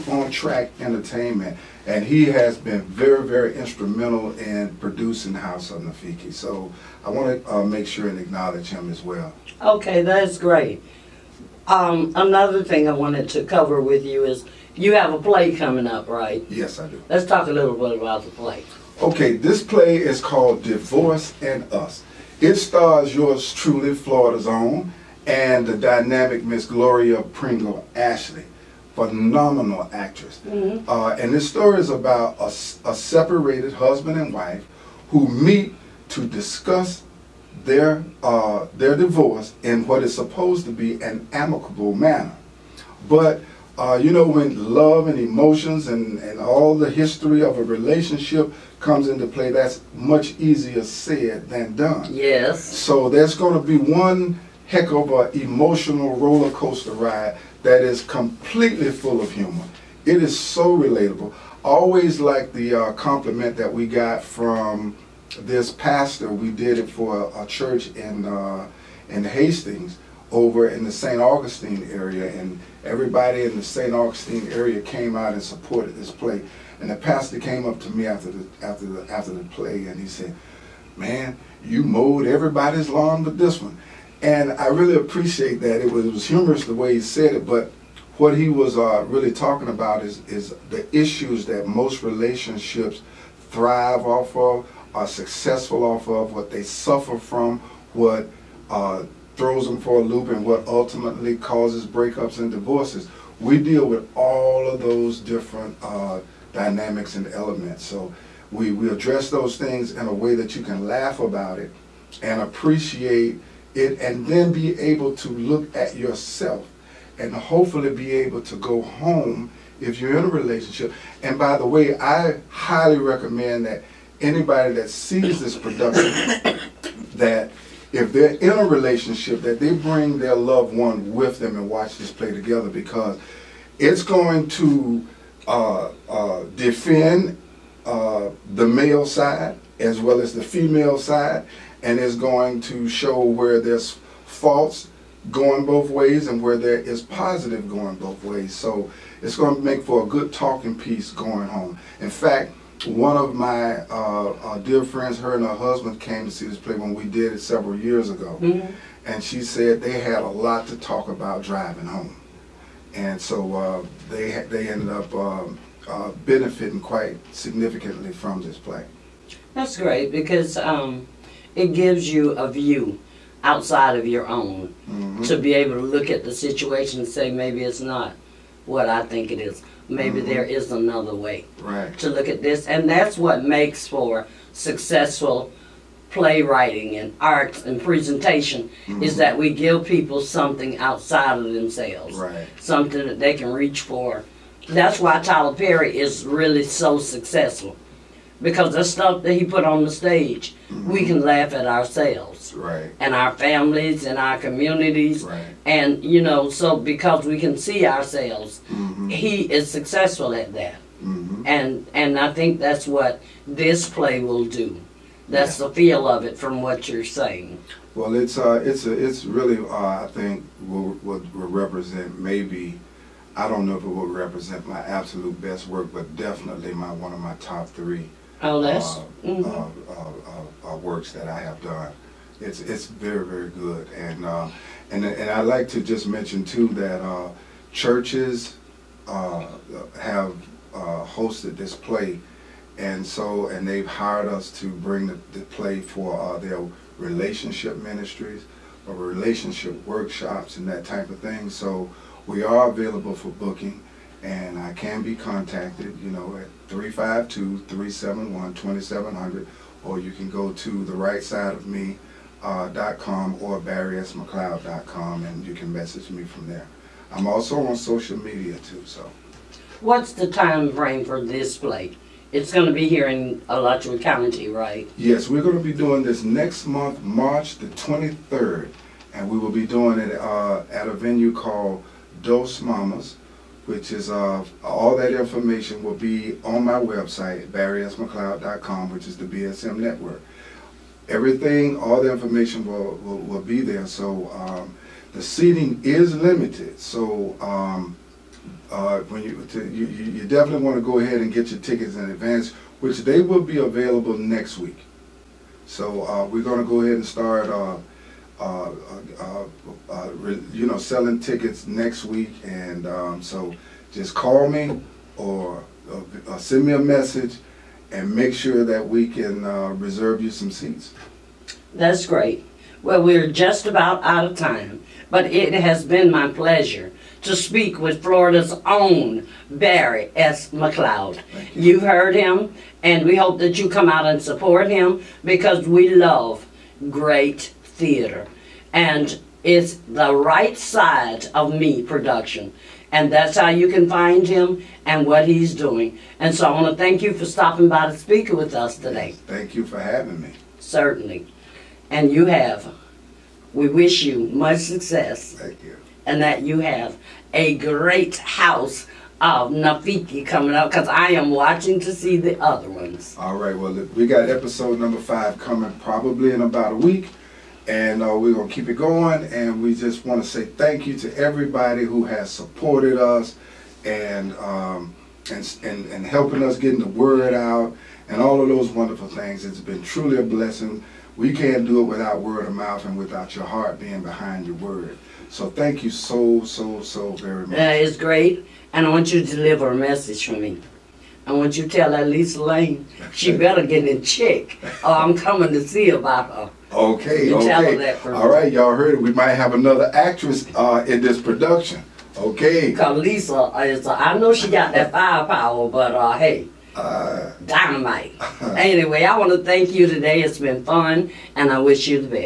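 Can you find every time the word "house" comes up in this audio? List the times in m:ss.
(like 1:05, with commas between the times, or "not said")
0:05, 5:58.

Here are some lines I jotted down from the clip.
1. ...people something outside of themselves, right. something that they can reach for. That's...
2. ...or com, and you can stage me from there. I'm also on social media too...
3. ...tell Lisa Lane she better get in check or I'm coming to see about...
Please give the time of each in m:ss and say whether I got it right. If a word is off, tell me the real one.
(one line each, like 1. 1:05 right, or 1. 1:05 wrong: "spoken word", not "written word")
1. 3:09 right
2. 4:23 wrong: "message", not "stage"
3. 6:31 right.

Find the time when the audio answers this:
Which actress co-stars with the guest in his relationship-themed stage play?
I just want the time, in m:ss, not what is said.
0:26.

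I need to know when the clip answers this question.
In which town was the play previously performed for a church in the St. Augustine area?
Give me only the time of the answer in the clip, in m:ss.
1:09.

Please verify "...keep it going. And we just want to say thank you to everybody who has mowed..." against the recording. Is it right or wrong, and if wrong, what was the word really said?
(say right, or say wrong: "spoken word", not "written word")
wrong: "supported", not "mowed".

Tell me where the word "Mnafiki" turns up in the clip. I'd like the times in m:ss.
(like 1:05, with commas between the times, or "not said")
0:05, 5:59.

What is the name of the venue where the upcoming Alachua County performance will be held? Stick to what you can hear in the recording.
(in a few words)
Dos Mamas.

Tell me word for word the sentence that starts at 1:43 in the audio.
We deal with all of those different uh, dynamics and elements.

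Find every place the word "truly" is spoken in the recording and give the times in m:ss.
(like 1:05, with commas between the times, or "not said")
0:23, 6:19.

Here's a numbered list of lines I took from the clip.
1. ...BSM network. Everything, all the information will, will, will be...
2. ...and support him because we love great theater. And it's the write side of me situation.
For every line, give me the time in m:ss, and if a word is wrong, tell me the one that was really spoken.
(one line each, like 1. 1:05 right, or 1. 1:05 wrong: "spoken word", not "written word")
1. 4:49 right
2. 5:34 wrong: "production", not "situation".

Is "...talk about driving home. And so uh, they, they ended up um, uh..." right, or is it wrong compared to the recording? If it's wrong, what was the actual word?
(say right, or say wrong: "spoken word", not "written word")
right.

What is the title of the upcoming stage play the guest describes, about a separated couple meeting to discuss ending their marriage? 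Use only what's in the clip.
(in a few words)
Divorce and Us.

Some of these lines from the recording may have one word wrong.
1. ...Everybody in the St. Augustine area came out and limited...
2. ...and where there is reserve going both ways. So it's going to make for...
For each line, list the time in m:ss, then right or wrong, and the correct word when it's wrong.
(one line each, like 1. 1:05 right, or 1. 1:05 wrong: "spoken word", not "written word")
1. 1:12 wrong: "supported", not "limited"
2. 2:26 wrong: "positive", not "reserve".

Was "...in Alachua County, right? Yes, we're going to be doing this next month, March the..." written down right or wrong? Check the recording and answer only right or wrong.
right.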